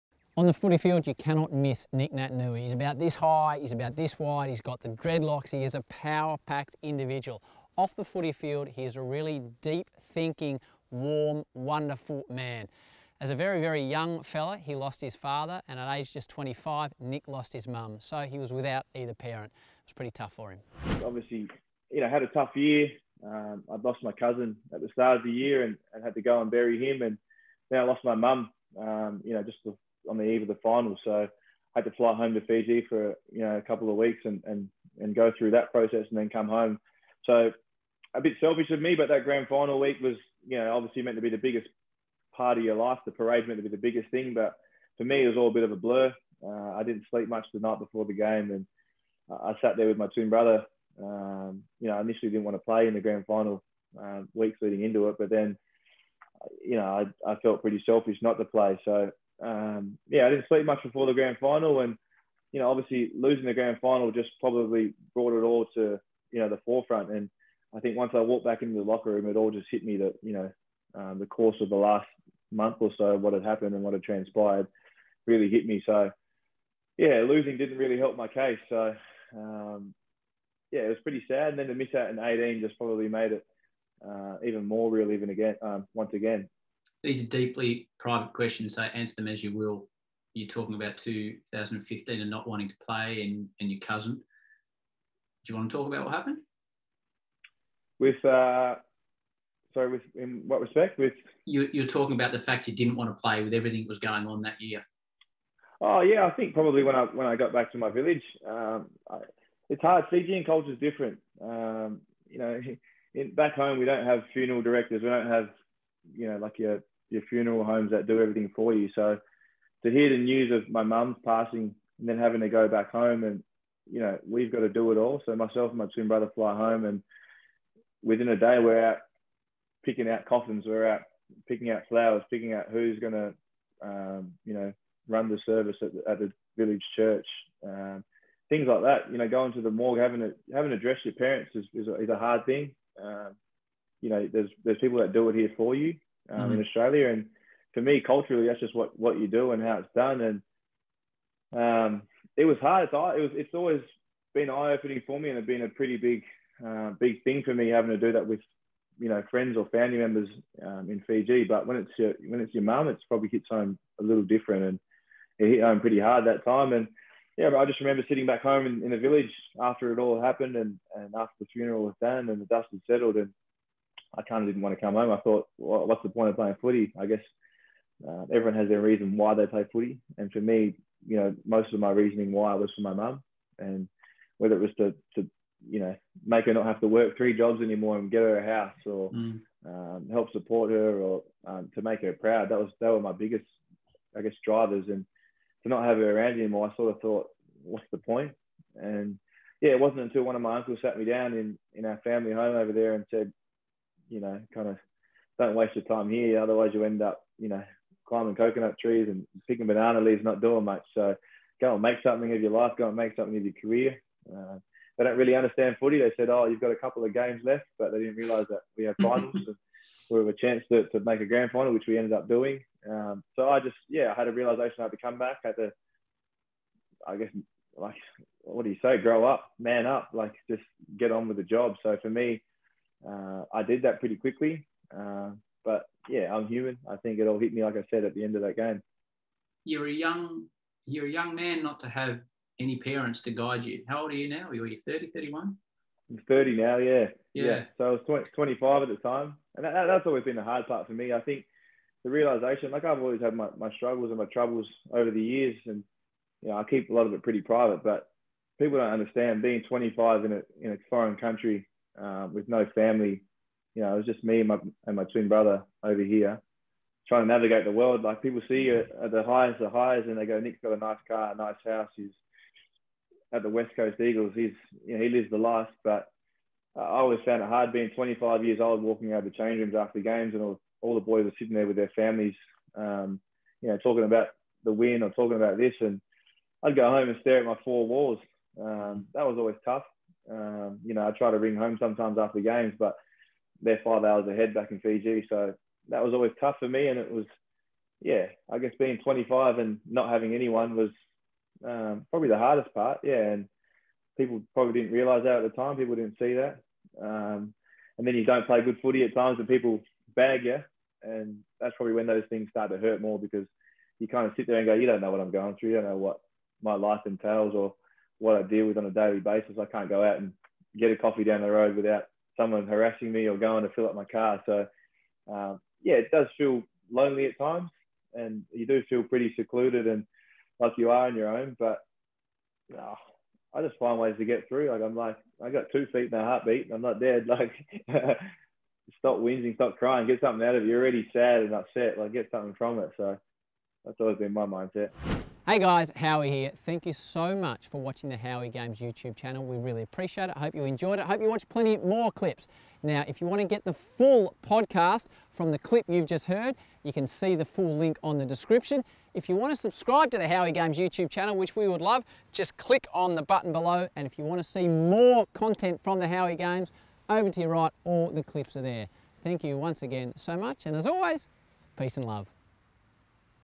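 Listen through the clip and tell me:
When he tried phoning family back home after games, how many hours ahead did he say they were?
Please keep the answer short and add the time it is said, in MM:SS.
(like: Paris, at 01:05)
5, at 04:53.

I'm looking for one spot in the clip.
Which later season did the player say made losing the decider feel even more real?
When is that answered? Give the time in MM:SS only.
01:22.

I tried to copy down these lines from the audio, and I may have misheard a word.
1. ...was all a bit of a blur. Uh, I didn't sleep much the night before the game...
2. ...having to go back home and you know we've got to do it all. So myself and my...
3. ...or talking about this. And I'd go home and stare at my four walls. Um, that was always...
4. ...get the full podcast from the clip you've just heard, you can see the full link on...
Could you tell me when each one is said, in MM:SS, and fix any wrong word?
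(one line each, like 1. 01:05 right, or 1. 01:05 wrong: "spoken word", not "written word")
1. 00:45 right
2. 02:02 right
3. 04:45 right
4. 05:53 right.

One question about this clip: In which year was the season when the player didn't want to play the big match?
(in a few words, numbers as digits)
2015.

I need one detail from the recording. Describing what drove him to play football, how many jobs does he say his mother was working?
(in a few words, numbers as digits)
3.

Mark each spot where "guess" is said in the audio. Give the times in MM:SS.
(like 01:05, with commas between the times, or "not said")
02:57, 03:14, 03:47, 04:58.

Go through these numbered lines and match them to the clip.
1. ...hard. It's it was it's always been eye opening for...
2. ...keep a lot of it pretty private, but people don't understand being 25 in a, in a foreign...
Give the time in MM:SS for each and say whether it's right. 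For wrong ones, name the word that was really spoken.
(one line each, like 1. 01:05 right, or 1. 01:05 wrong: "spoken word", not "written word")
1. 02:32 right
2. 04:16 right.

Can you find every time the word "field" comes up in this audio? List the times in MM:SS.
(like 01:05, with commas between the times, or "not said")
00:00, 00:08.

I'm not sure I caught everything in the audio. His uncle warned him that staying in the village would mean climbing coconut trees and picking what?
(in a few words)
Banana leaves.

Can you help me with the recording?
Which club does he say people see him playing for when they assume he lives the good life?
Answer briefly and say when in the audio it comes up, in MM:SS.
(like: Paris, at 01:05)
West Coast Eagles, at 04:33.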